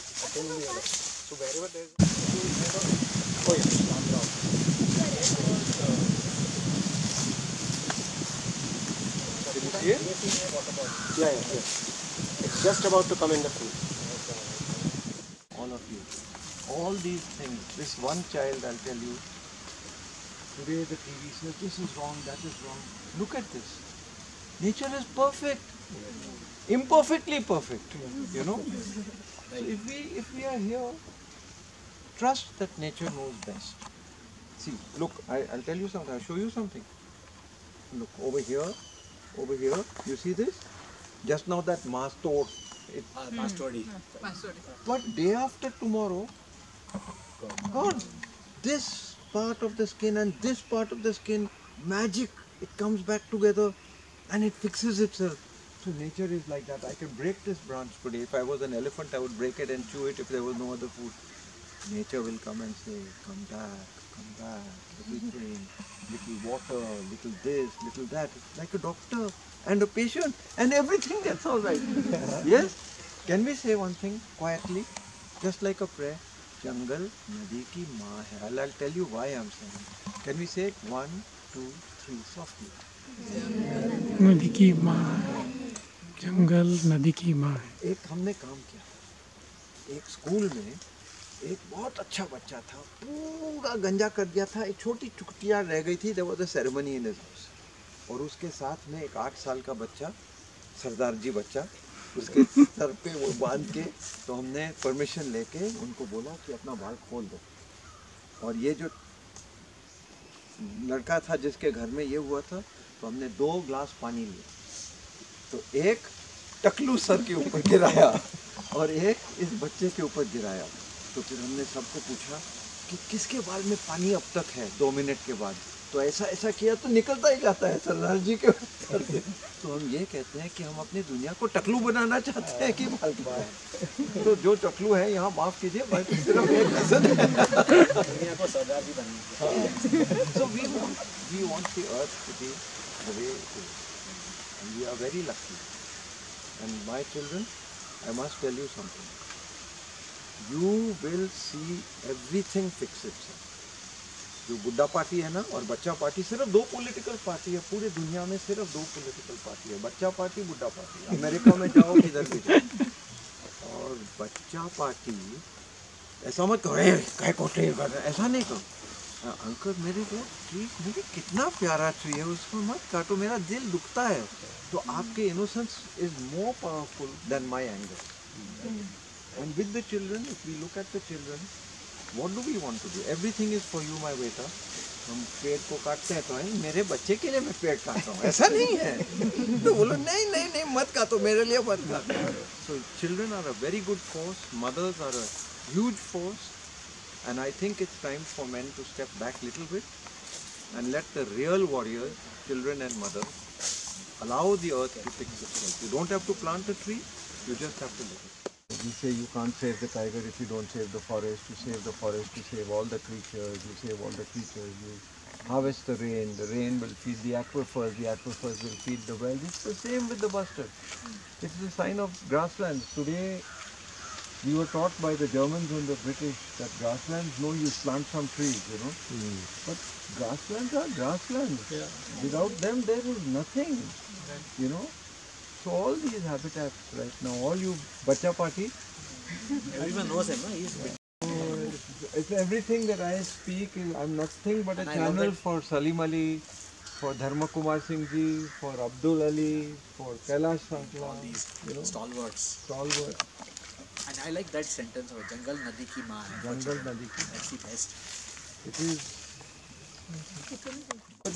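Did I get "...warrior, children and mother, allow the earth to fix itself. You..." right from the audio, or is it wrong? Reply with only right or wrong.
right.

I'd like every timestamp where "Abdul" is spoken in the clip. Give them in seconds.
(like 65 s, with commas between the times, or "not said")
248 s.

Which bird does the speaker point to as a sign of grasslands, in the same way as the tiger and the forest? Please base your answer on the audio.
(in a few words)
The bustard.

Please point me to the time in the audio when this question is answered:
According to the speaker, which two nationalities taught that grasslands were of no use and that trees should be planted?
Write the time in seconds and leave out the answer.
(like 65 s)
225 s.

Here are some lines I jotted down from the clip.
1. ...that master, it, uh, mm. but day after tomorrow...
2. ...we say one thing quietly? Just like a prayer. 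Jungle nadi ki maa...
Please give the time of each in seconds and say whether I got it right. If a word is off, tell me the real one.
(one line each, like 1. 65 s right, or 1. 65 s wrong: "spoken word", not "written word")
1. 41 s right
2. 73 s right.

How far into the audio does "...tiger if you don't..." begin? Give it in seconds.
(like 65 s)
209 s.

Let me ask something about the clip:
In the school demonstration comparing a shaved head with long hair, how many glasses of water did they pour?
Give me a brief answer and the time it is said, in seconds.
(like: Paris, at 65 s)
2 glasses, at 113 s.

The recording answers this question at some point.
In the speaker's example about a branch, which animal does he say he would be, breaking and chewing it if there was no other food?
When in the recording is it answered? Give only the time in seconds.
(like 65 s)
58 s.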